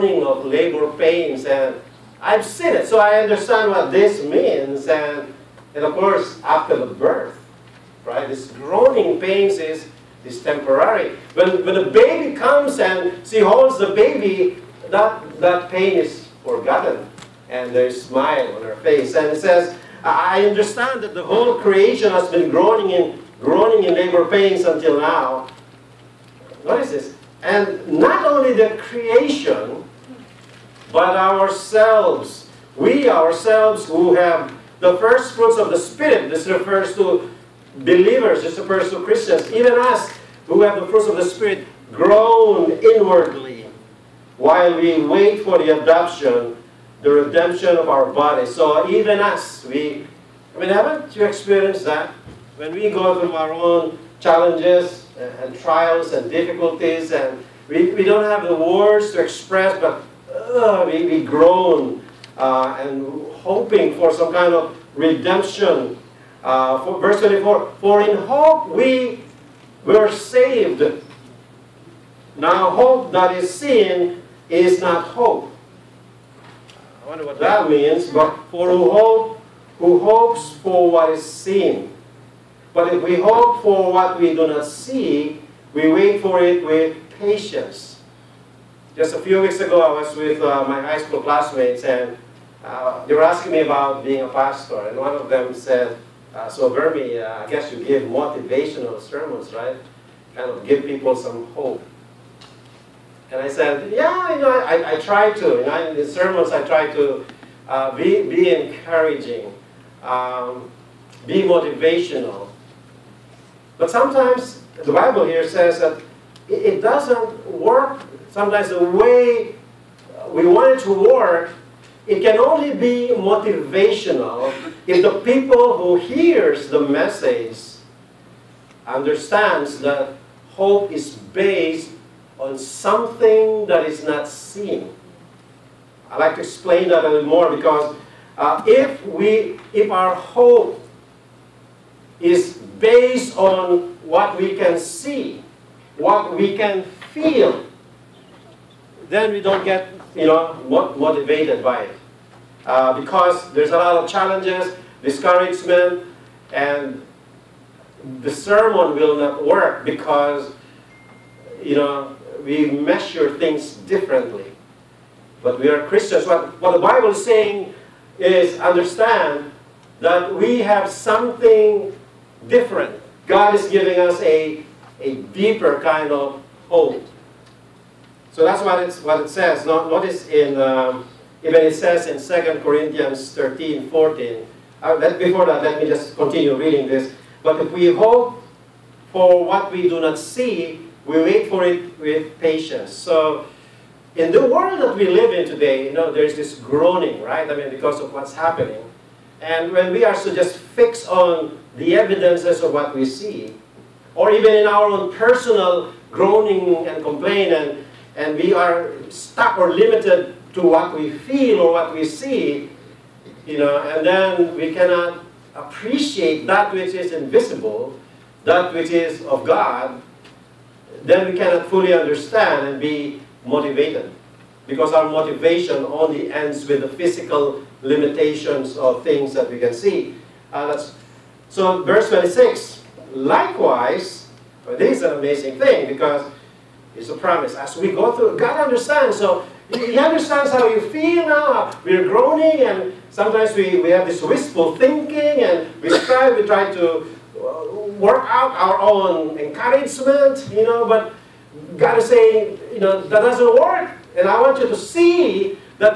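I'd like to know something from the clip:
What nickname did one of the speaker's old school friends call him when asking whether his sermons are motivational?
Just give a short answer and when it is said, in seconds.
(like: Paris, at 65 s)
Bermie, at 96 s.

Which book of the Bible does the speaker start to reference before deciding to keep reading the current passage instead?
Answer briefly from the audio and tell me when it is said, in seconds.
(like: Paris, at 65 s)
2 Corinthians, at 182 s.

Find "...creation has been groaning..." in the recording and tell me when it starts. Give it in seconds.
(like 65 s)
21 s.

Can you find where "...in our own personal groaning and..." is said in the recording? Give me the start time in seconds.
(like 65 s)
204 s.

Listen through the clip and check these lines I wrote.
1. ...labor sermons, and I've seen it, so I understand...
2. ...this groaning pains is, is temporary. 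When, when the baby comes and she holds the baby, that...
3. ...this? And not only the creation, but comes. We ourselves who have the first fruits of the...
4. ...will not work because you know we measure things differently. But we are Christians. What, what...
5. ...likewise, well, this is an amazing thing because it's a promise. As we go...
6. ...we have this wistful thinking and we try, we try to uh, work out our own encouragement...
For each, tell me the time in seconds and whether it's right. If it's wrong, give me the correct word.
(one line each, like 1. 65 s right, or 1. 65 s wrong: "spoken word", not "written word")
1. 0 s wrong: "pains", not "sermons"
2. 8 s right
3. 26 s wrong: "ourselves", not "comes"
4. 158 s right
5. 233 s right
6. 243 s right.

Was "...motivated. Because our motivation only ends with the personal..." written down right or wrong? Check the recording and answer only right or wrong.
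wrong.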